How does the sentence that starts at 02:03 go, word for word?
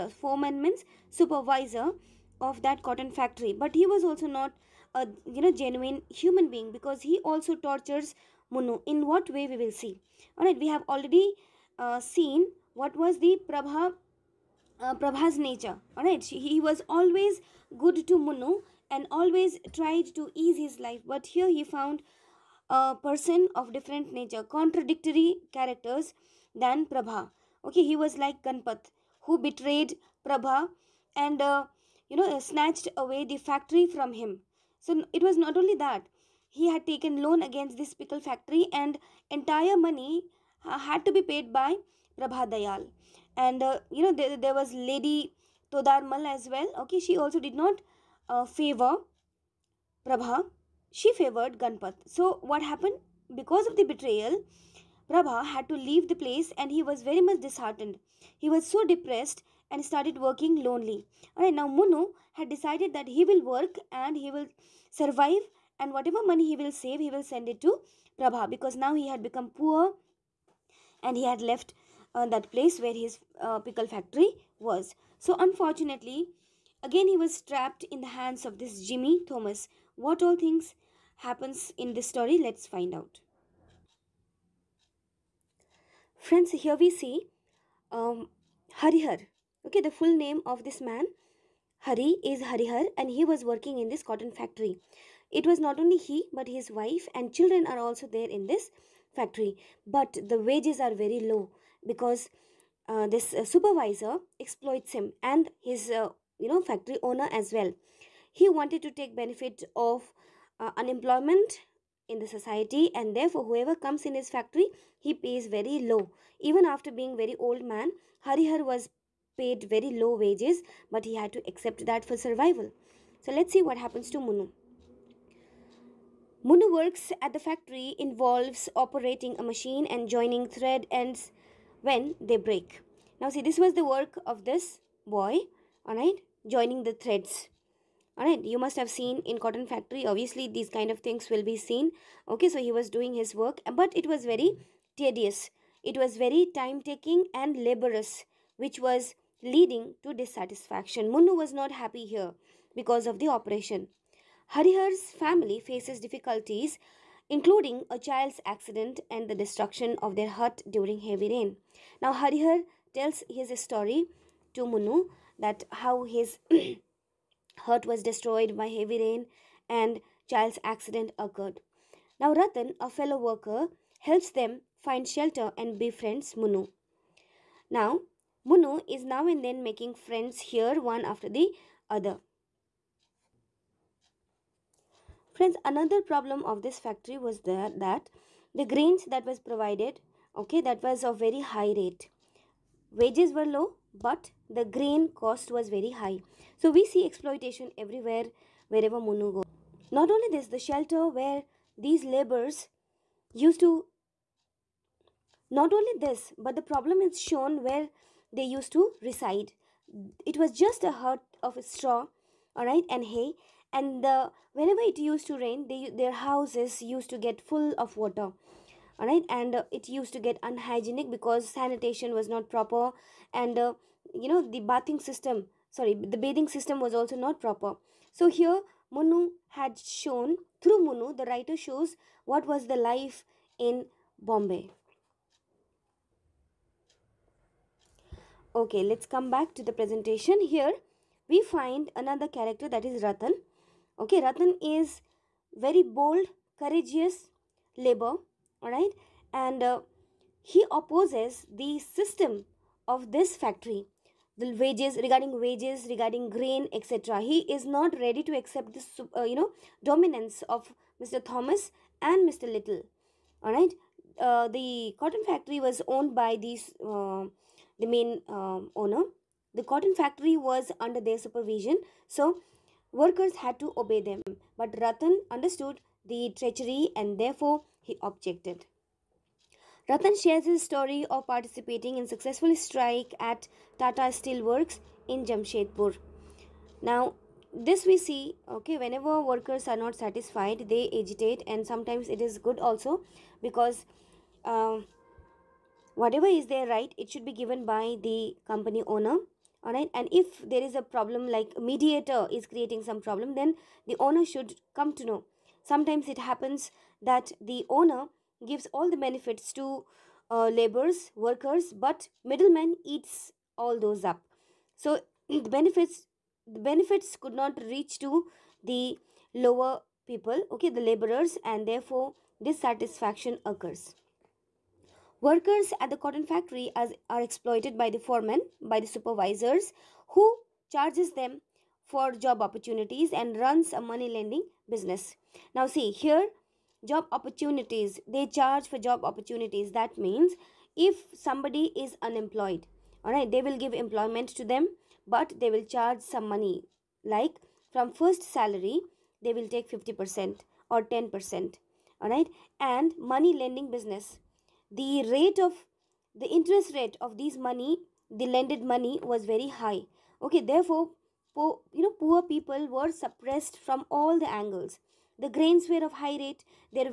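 So let's see what happens to Munoo.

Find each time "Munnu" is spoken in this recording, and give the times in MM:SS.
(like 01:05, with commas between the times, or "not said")
02:31, 02:44.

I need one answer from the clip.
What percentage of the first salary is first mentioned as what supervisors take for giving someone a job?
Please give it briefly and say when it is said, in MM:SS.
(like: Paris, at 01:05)
50%, at 05:49.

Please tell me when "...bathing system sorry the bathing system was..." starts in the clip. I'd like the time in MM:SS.
03:44.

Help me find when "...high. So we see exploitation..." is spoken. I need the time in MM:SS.
03:15.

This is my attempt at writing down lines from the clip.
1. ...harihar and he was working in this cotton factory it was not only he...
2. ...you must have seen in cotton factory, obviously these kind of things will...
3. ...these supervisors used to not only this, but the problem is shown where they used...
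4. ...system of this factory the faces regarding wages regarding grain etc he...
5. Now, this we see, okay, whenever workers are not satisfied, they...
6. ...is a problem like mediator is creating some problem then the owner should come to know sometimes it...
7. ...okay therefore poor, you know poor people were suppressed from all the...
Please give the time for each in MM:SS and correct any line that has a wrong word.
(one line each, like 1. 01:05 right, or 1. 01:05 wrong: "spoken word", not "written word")
1. 01:32 right
2. 02:18 right
3. 03:21 wrong: "laborers", not "supervisors"
4. 04:11 wrong: "wages", not "faces"
5. 04:46 right
6. 05:00 right
7. 06:00 right.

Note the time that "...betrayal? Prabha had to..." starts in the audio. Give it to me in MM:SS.
00:53.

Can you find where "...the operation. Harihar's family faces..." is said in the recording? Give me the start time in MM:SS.
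02:33.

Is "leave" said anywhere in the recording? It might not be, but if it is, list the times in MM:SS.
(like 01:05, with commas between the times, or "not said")
00:55.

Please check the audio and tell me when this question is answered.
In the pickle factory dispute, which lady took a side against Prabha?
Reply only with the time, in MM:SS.
00:44.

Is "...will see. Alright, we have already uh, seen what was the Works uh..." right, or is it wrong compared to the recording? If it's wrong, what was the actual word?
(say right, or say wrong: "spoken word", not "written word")
wrong: "Prabha", not "Works".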